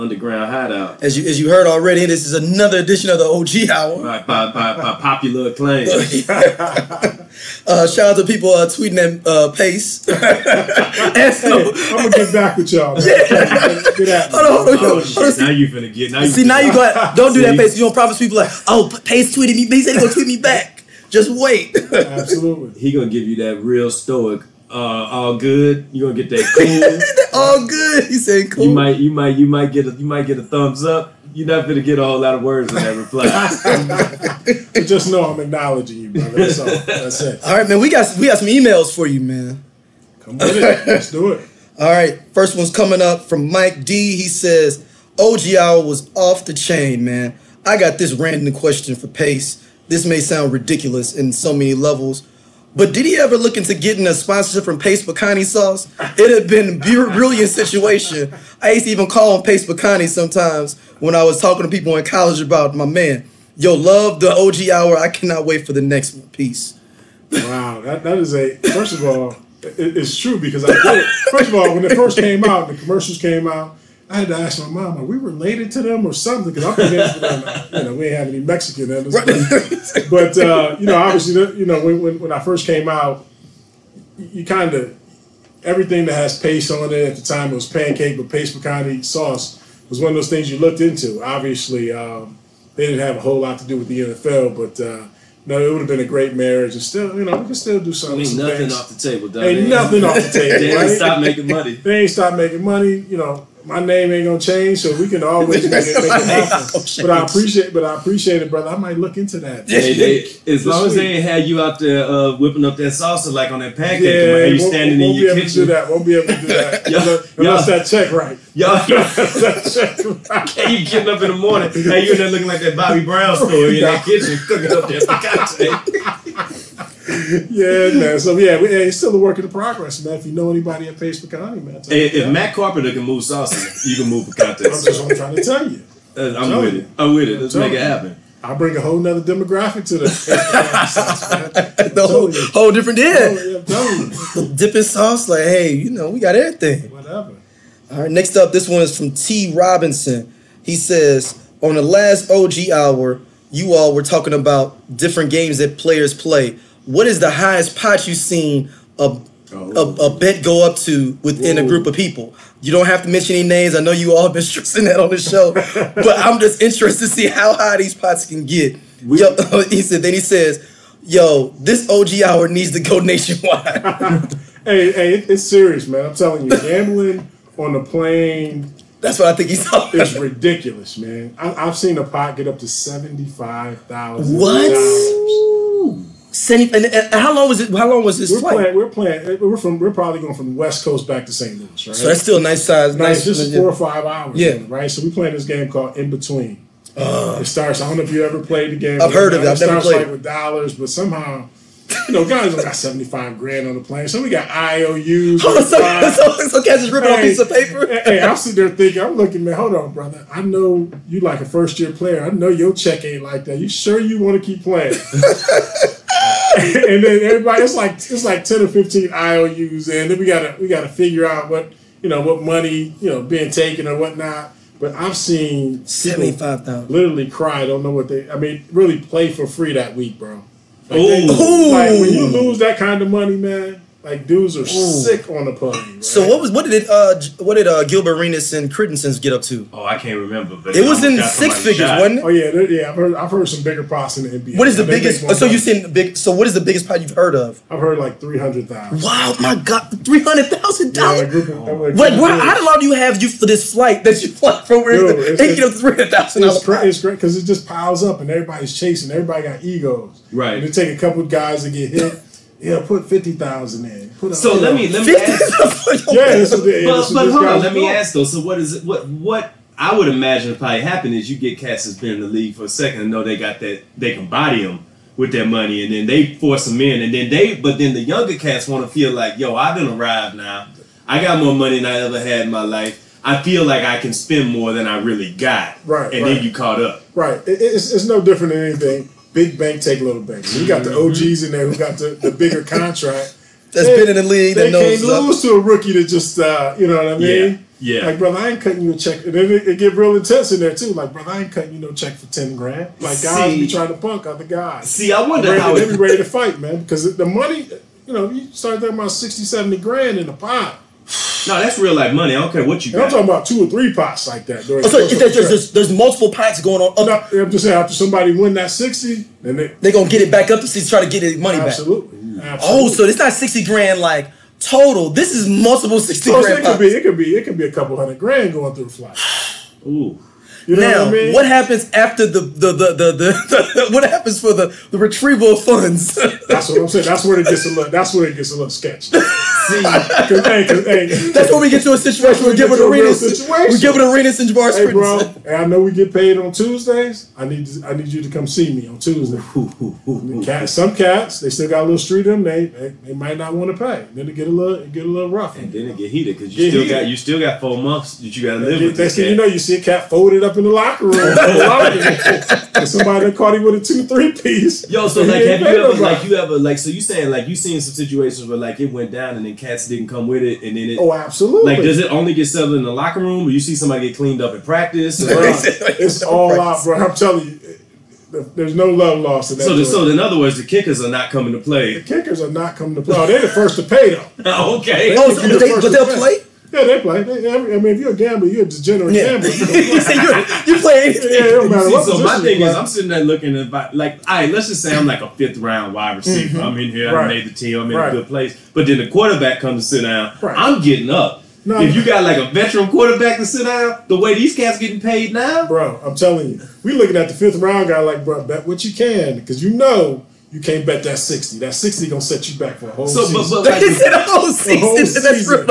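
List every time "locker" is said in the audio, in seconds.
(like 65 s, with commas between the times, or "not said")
360 s, 372 s.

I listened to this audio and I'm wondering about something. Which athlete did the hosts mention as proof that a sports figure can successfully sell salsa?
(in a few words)
Matt Carpenter.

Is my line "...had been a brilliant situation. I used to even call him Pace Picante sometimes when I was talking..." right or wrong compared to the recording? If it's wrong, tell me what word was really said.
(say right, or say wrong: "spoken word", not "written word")
right.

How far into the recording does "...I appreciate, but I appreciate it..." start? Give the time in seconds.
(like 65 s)
107 s.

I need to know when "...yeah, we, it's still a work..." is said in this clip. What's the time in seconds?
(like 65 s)
128 s.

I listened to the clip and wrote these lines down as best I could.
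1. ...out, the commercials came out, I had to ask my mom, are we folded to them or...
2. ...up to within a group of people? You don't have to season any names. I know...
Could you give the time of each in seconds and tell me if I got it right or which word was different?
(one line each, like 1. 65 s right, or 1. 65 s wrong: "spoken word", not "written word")
1. 72 s wrong: "related", not "folded"
2. 160 s wrong: "mention", not "season".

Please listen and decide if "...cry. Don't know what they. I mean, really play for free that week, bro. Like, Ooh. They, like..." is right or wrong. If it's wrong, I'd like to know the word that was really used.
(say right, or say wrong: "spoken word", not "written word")
right.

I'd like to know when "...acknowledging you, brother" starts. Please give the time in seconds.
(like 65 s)
35 s.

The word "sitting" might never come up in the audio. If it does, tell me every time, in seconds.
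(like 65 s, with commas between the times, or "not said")
208 s, 392 s.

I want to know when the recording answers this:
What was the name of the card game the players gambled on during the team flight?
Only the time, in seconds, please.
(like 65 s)
195 s.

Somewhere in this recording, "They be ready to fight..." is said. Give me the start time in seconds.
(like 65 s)
305 s.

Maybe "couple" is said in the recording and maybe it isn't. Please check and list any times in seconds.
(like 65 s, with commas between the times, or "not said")
260 s, 327 s.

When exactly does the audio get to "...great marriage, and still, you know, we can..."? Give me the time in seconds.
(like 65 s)
96 s.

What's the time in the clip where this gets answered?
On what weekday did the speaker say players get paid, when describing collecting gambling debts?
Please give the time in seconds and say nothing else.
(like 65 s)
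346 s.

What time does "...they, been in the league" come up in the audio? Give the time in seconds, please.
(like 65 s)
293 s.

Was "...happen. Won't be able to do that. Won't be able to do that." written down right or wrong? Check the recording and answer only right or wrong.
wrong.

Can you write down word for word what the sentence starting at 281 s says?
I got more money than I ever had in my life.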